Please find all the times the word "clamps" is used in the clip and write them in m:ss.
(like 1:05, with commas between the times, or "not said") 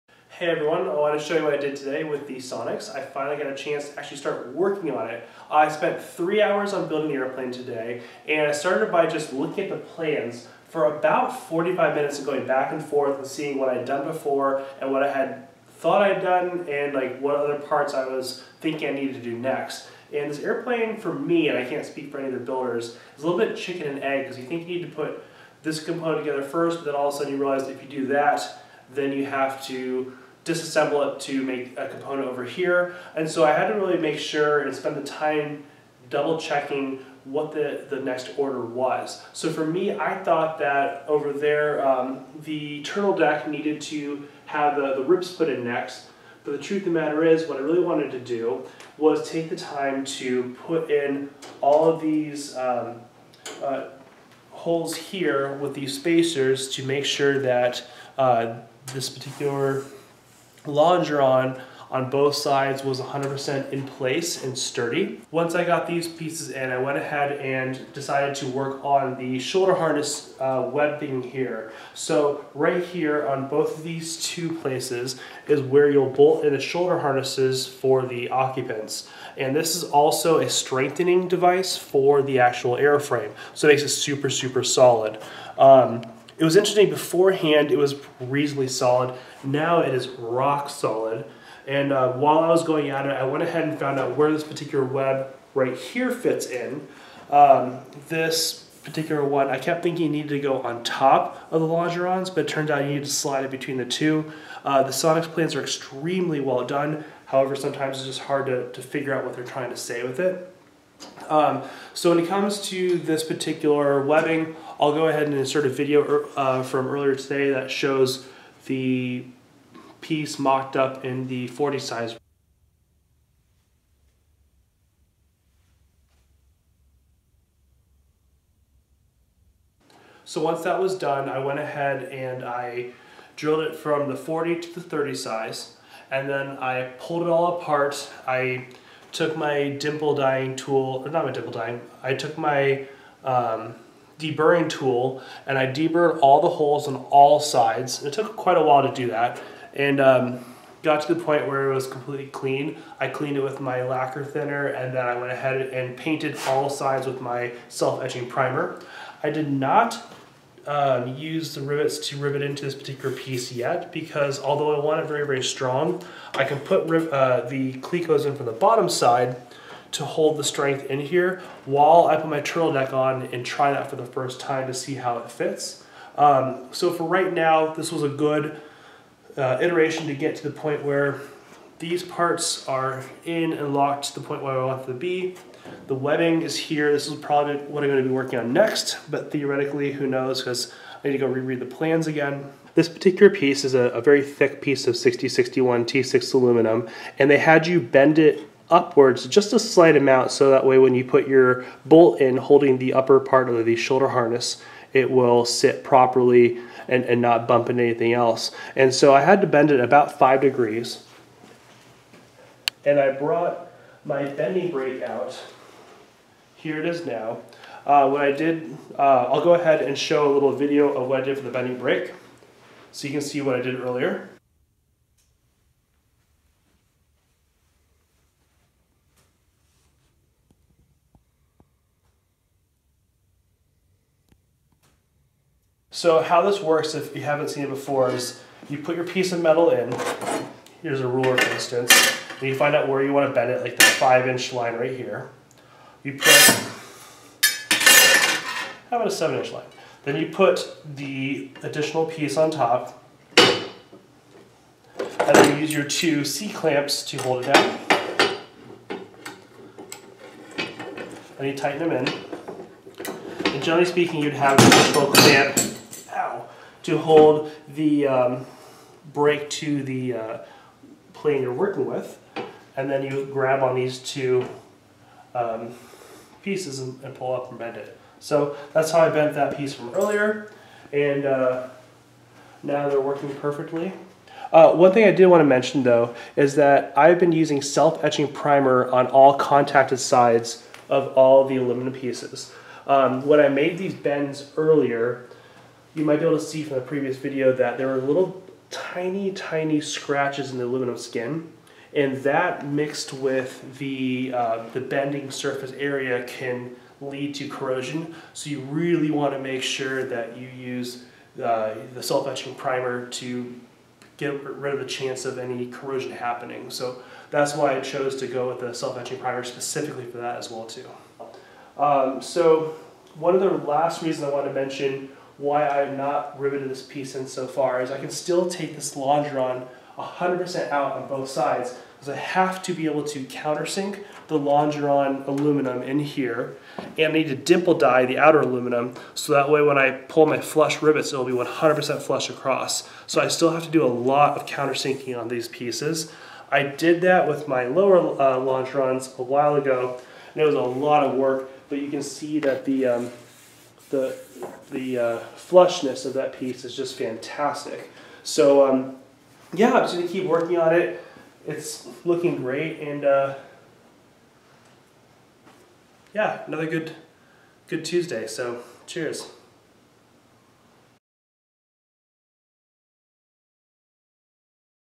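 4:16, 4:25.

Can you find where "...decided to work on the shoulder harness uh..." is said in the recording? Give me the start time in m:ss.
1:07.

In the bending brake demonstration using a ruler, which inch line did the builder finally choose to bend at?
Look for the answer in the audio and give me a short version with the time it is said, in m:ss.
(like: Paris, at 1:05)
7 inch, at 4:09.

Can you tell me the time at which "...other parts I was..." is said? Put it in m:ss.
0:17.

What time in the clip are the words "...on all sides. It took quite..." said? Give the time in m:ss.
2:26.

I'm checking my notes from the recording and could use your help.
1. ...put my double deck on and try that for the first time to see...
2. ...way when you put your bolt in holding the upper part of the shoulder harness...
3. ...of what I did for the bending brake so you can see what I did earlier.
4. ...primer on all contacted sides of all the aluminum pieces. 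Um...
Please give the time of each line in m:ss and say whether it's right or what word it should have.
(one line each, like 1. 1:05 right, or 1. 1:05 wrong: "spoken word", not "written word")
1. 2:52 wrong: "turtle", not "double"
2. 3:20 right
3. 3:40 right
4. 4:48 right.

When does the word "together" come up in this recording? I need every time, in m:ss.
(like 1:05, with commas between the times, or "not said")
0:26.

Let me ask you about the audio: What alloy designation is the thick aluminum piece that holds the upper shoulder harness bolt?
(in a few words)
6061 T6.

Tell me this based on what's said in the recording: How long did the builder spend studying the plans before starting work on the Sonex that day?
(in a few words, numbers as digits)
45 minutes.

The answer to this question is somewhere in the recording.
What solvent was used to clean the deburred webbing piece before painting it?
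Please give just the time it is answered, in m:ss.
2:33.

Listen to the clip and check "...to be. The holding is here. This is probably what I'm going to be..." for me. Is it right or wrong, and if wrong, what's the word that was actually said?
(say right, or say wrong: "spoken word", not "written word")
wrong: "webbing", not "holding".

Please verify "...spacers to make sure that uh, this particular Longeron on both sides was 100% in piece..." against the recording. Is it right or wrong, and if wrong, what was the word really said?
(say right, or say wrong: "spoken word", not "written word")
wrong: "place", not "piece".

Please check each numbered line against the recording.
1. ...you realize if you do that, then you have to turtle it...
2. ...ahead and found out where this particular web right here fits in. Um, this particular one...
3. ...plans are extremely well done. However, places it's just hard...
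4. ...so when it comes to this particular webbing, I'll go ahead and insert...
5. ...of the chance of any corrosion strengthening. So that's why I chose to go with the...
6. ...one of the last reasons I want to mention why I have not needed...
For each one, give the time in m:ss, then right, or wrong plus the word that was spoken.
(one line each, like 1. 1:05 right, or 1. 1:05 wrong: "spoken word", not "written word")
1. 0:27 wrong: "disassemble", not "turtle"
2. 1:33 right
3. 1:45 wrong: "sometimes", not "places"
4. 1:51 right
5. 5:14 wrong: "happening", not "strengthening"
6. 5:23 wrong: "riveted", not "needed".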